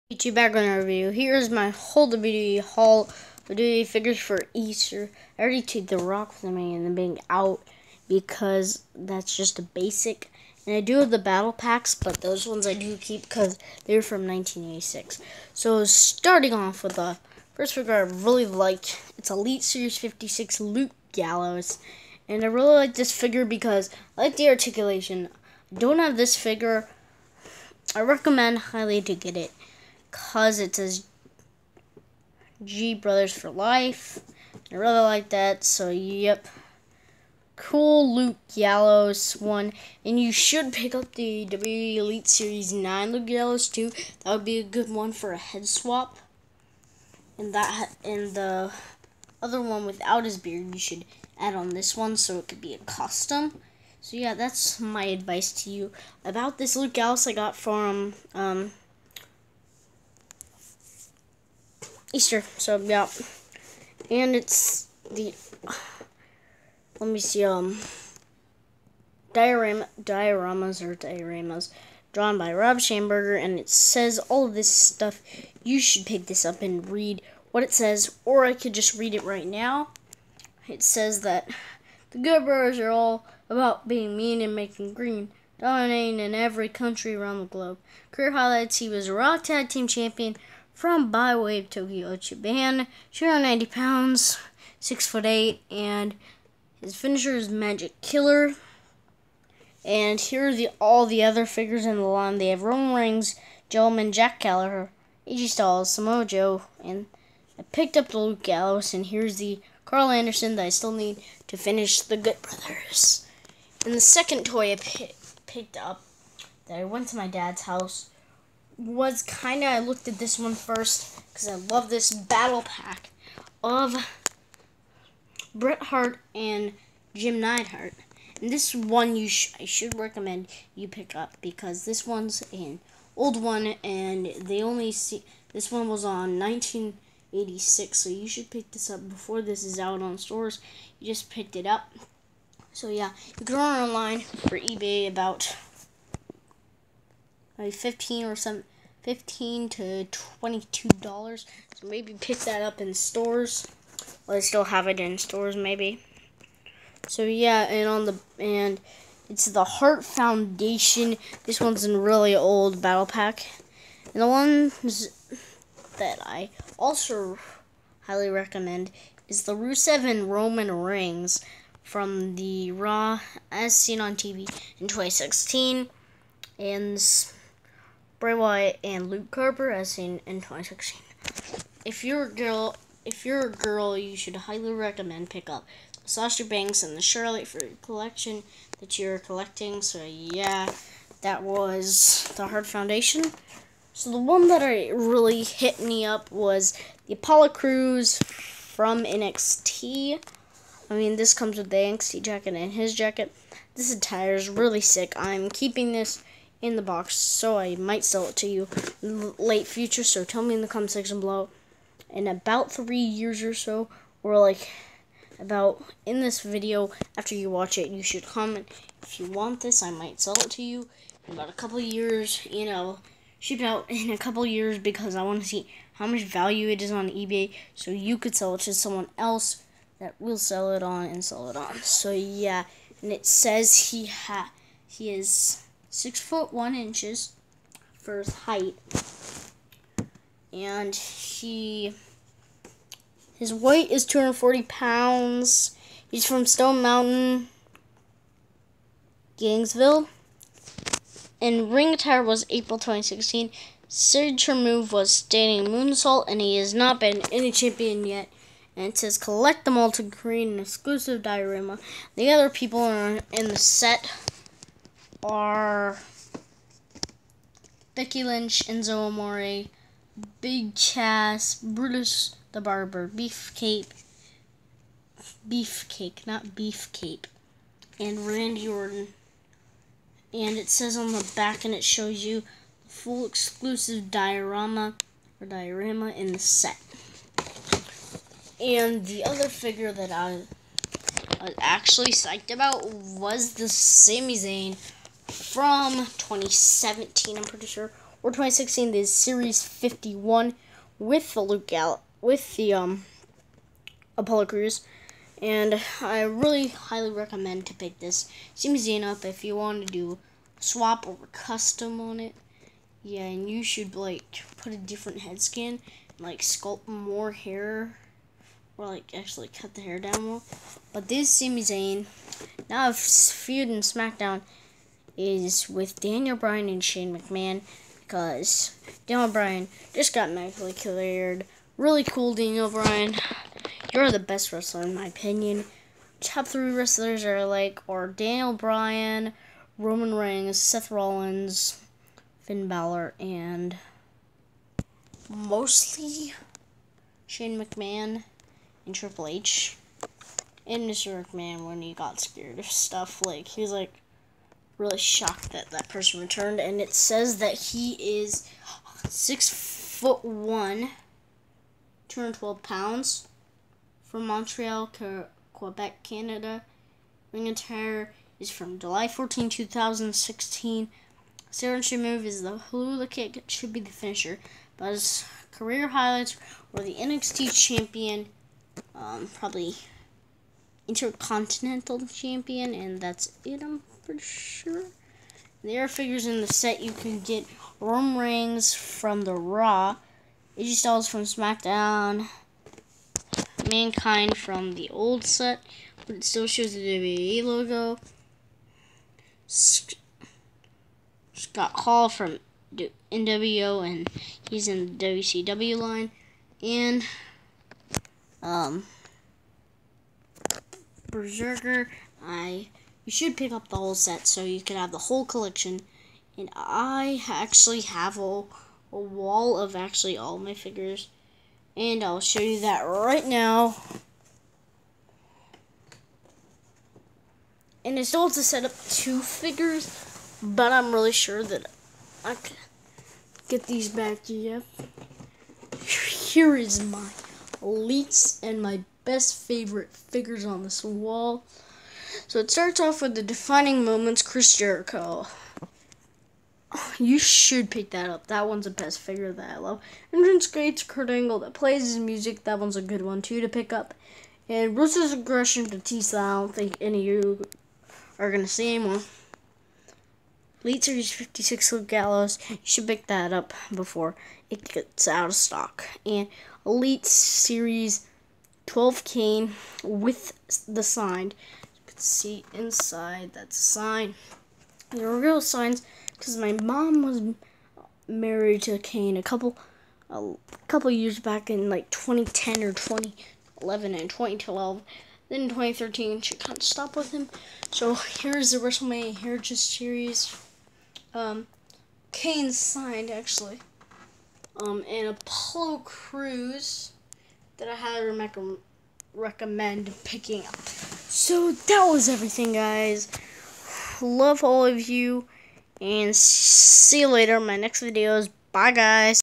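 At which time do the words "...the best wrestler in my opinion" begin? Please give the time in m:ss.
5:34.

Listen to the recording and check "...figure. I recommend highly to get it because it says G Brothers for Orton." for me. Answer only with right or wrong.
wrong.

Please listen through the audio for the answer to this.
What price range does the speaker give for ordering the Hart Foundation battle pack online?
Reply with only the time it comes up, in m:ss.
2:29.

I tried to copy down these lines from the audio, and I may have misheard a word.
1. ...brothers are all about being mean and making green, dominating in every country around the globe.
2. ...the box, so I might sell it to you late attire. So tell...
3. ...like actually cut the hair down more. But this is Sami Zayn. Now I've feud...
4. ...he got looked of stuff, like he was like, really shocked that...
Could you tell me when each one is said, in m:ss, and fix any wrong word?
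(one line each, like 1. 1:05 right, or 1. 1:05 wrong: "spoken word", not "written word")
1. 1:22 right
2. 3:26 wrong: "future", not "attire"
3. 5:18 right
4. 5:51 wrong: "scared", not "looked".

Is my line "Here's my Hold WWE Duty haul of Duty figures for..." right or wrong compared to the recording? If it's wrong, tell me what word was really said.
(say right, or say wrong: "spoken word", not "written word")
right.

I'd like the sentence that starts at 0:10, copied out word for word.
And I do have the battle packs, but those ones I do keep because they're from 1986.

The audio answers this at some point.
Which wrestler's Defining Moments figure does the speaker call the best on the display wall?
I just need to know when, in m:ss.
7:24.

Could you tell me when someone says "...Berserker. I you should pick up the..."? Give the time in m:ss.
6:51.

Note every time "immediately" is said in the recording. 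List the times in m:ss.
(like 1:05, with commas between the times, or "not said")
not said.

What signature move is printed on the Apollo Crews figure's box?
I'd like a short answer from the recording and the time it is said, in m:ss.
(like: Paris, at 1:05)
Standing moonsault, at 4:15.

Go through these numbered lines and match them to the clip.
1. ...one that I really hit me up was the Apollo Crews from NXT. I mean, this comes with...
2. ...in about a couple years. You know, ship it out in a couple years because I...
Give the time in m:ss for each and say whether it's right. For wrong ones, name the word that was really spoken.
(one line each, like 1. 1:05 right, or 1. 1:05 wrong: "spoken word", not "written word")
1. 3:14 right
2. 3:41 right.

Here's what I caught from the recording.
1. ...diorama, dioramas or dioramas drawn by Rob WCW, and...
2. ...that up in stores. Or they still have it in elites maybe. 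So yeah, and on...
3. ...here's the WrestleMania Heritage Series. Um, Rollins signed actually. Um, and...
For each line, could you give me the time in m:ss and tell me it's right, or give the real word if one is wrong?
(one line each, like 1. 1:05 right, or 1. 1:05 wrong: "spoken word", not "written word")
1. 1:09 wrong: "Schamberger", not "WCW"
2. 2:32 wrong: "stores", not "elites"
3. 8:07 wrong: "Kane", not "Rollins".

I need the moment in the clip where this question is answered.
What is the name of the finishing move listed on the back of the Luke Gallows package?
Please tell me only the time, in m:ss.
1:37.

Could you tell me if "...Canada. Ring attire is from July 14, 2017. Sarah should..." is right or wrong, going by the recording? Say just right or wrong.
wrong.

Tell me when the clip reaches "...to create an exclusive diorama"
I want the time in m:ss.
4:19.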